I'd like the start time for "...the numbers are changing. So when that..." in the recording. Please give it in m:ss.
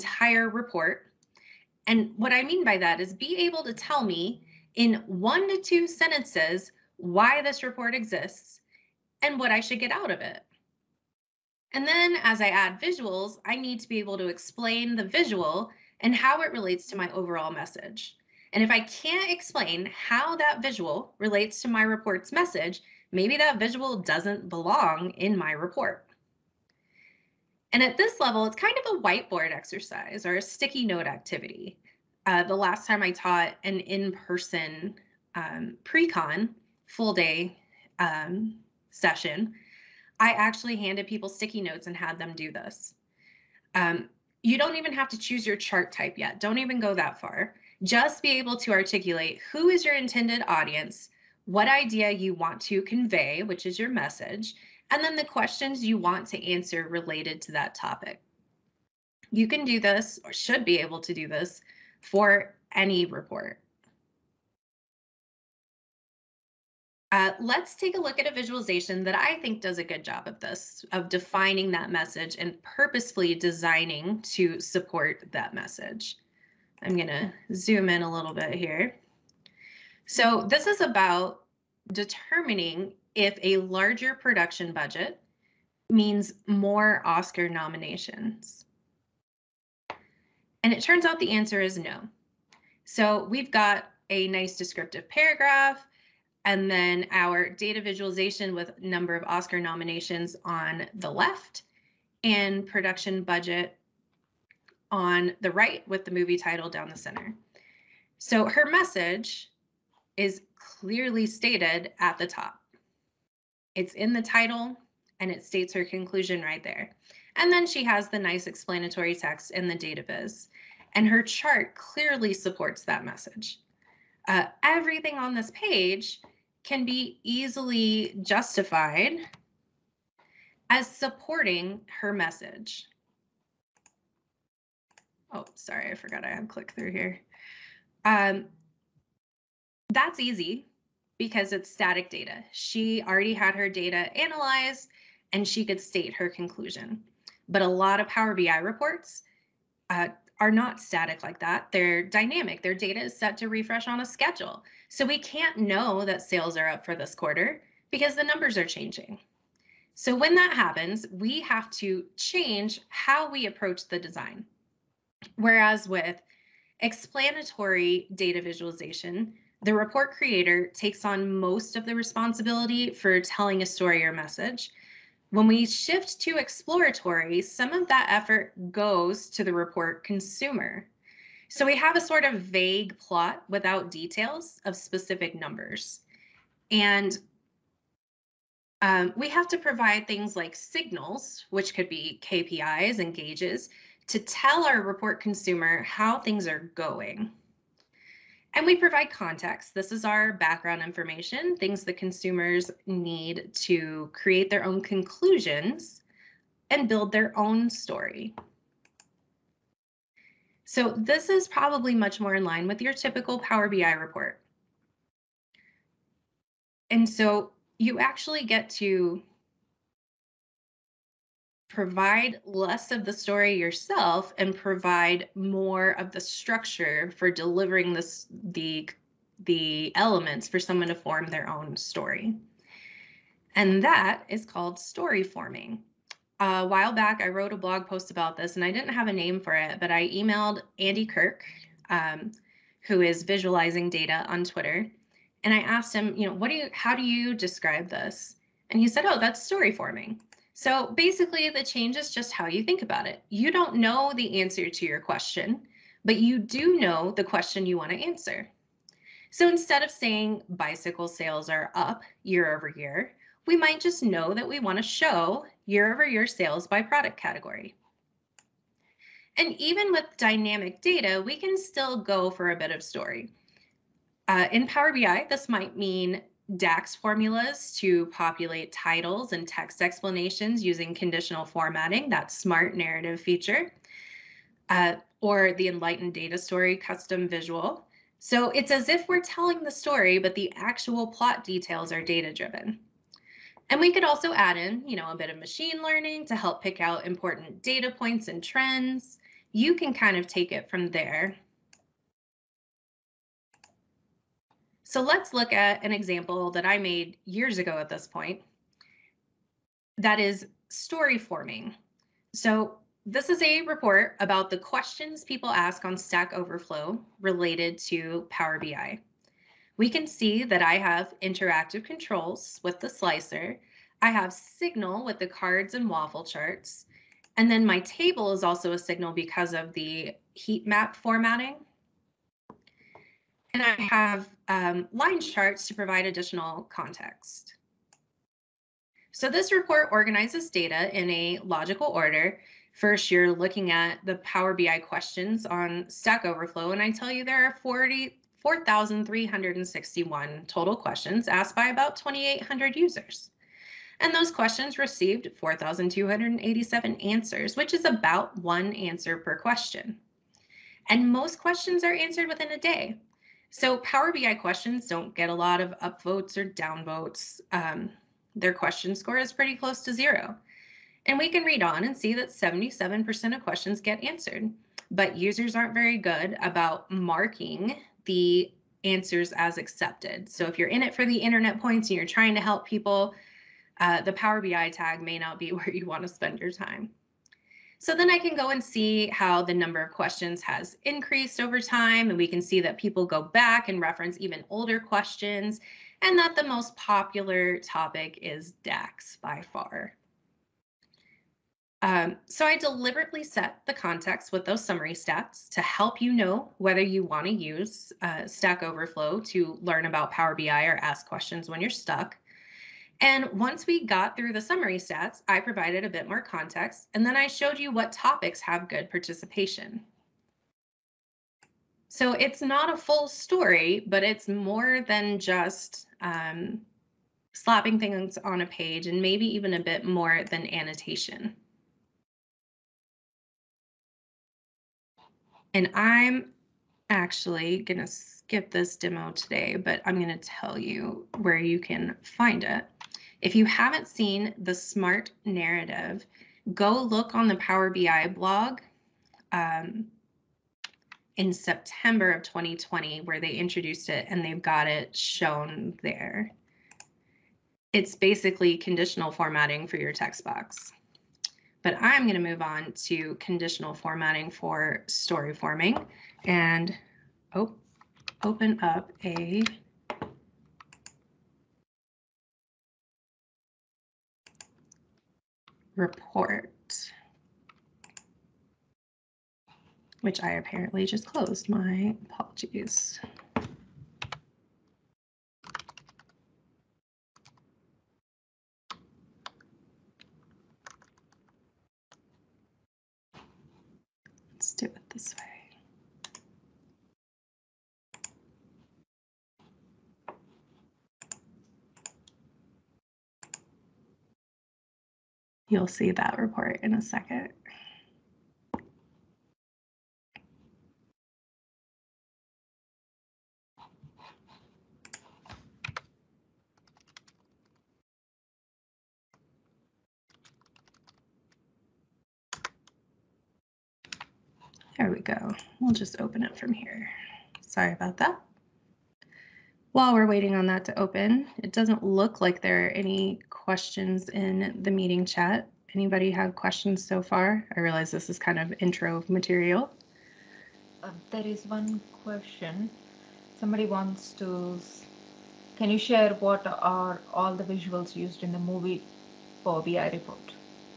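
2:38.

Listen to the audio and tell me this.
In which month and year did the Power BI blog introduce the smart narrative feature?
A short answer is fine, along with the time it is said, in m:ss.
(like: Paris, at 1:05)
September 2020, at 7:31.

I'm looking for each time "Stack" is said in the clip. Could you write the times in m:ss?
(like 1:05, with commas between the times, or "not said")
5:15, 5:45, 6:48.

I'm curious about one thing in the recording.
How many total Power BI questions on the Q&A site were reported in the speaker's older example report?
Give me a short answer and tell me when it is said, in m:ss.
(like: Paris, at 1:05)
4,361, at 5:47.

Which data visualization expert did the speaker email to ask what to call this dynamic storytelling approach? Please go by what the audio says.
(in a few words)
Andy Kirk.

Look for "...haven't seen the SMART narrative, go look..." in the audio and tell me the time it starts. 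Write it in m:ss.
7:23.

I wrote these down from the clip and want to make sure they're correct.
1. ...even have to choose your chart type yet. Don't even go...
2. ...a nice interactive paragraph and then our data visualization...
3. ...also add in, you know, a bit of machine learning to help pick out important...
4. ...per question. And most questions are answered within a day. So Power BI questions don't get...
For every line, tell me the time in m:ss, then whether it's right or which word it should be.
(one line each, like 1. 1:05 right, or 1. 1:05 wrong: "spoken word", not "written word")
1. 0:44 right
2. 1:34 wrong: "descriptive", not "interactive"
3. 4:54 right
4. 5:59 right.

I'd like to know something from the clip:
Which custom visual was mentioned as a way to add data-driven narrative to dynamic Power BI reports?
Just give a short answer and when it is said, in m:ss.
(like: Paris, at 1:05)
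Enlighten Data Story, at 4:45.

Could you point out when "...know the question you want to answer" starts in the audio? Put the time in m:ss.
4:16.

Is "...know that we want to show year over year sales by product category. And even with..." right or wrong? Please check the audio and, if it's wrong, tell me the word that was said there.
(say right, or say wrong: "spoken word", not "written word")
right.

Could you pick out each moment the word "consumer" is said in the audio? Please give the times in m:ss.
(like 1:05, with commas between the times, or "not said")
3:00, 3:15, 3:21.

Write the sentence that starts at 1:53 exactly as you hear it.
It's in the title and it states her conclusion right there.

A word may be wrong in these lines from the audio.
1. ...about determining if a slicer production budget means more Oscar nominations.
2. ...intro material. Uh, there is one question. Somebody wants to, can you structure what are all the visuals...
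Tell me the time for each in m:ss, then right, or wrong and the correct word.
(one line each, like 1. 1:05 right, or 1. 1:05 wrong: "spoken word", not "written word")
1. 1:20 wrong: "larger", not "slicer"
2. 8:58 wrong: "share", not "structure".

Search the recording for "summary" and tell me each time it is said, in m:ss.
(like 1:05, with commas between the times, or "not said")
6:44, 6:54.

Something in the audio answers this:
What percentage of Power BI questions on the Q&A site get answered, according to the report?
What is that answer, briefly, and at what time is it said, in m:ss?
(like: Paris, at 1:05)
77%, at 6:12.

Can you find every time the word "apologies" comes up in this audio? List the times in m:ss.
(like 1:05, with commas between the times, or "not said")
8:02.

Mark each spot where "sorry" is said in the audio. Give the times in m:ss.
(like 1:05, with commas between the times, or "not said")
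2:15, 8:47.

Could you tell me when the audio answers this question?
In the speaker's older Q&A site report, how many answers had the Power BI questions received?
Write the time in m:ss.
5:55.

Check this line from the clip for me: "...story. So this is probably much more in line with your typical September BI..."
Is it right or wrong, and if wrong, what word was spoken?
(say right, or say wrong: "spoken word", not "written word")
wrong: "Power", not "September".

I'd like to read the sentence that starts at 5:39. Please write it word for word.
So this report organizes data in a logical order.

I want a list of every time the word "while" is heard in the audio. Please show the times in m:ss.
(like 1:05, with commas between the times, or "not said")
3:56, 8:49.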